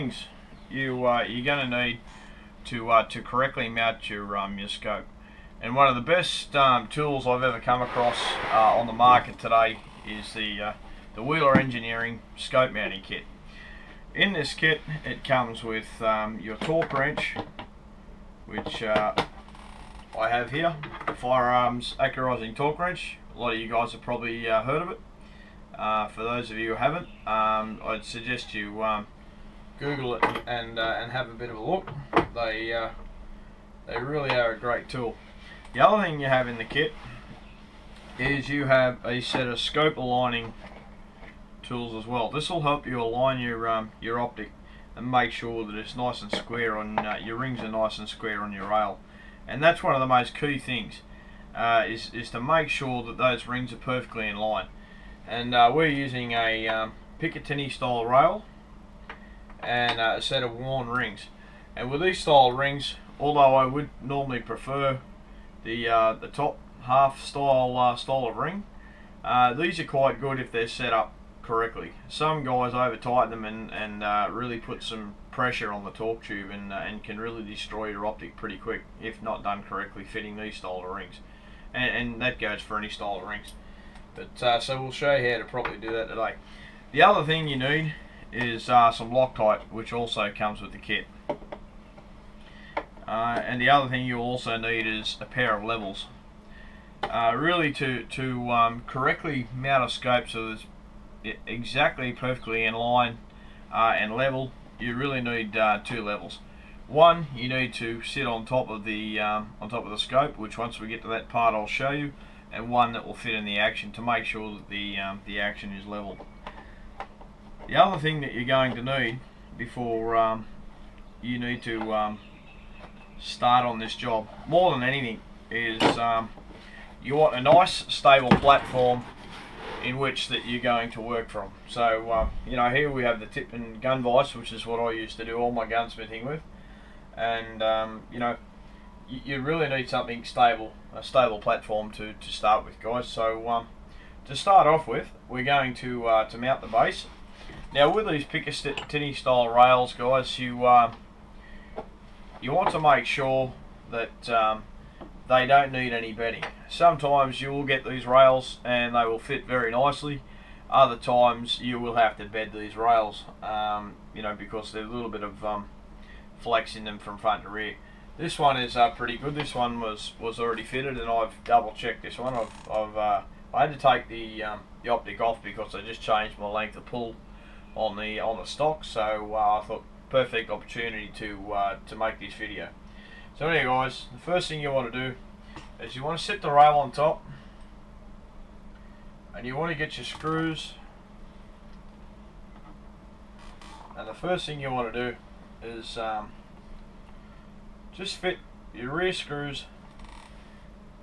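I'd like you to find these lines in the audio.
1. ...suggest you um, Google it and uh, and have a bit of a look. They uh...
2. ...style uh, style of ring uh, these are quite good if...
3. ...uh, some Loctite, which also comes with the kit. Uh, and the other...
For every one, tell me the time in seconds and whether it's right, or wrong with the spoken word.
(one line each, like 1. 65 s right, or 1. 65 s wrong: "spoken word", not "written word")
1. 28 s right
2. 67 s right
3. 88 s right.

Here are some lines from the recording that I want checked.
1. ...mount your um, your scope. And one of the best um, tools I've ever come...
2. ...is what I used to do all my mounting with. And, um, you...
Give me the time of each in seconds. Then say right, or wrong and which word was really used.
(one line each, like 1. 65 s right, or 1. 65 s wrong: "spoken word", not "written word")
1. 3 s right
2. 134 s wrong: "gunsmithing", not "mounting".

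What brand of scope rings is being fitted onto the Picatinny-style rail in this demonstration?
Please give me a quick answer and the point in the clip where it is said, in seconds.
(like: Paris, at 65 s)
Warne, at 60 s.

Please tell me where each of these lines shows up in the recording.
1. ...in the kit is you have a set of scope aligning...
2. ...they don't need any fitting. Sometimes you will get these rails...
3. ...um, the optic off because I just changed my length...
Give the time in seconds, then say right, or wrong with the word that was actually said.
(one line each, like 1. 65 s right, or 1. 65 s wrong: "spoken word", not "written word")
1. 36 s right
2. 155 s wrong: "bedding", not "fitting"
3. 174 s right.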